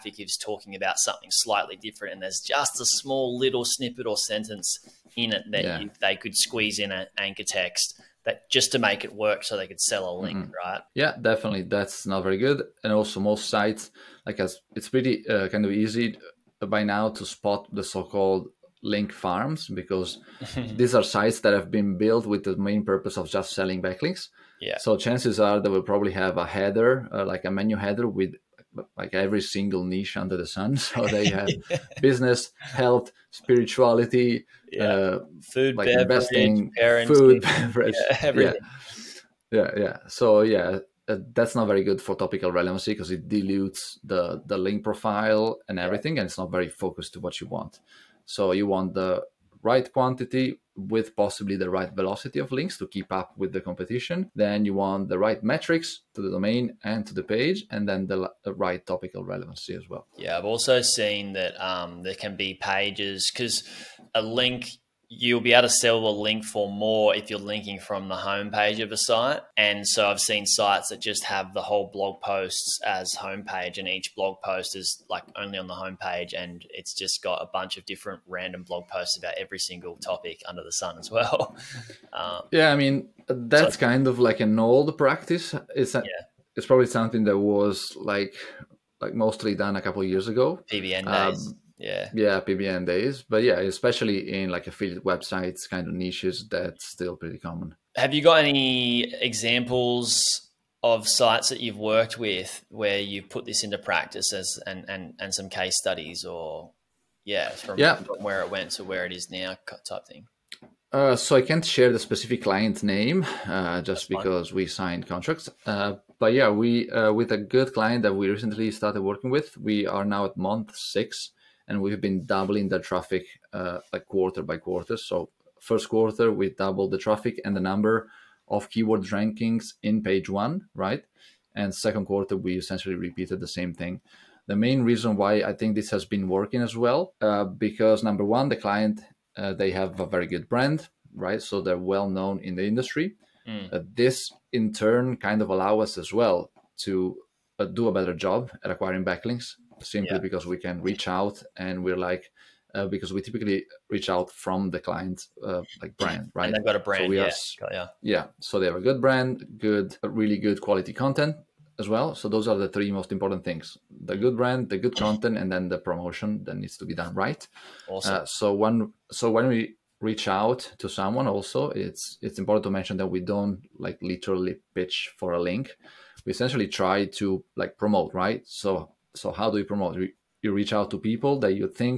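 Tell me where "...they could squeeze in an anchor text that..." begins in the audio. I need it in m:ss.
0:06.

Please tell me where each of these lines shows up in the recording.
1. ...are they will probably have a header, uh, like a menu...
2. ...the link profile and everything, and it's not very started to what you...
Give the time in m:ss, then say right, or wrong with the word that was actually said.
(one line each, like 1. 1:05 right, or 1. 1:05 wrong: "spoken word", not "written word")
1. 0:25 right
2. 0:44 wrong: "focused", not "started".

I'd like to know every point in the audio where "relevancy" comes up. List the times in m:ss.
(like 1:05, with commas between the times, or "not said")
0:42, 0:59.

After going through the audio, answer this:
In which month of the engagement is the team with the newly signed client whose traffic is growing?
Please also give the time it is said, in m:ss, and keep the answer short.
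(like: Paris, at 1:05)
6, at 2:00.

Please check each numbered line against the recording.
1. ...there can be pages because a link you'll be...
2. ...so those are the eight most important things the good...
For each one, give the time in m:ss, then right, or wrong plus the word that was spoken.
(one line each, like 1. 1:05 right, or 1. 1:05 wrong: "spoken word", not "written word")
1. 1:02 right
2. 2:42 wrong: "three", not "eight".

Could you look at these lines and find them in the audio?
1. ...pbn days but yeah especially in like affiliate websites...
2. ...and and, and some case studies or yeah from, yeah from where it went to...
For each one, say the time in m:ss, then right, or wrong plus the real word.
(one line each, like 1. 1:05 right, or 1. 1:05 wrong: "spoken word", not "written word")
1. 1:32 right
2. 1:44 right.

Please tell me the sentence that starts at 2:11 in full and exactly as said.
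And second quarter we essentially repeated the same thing.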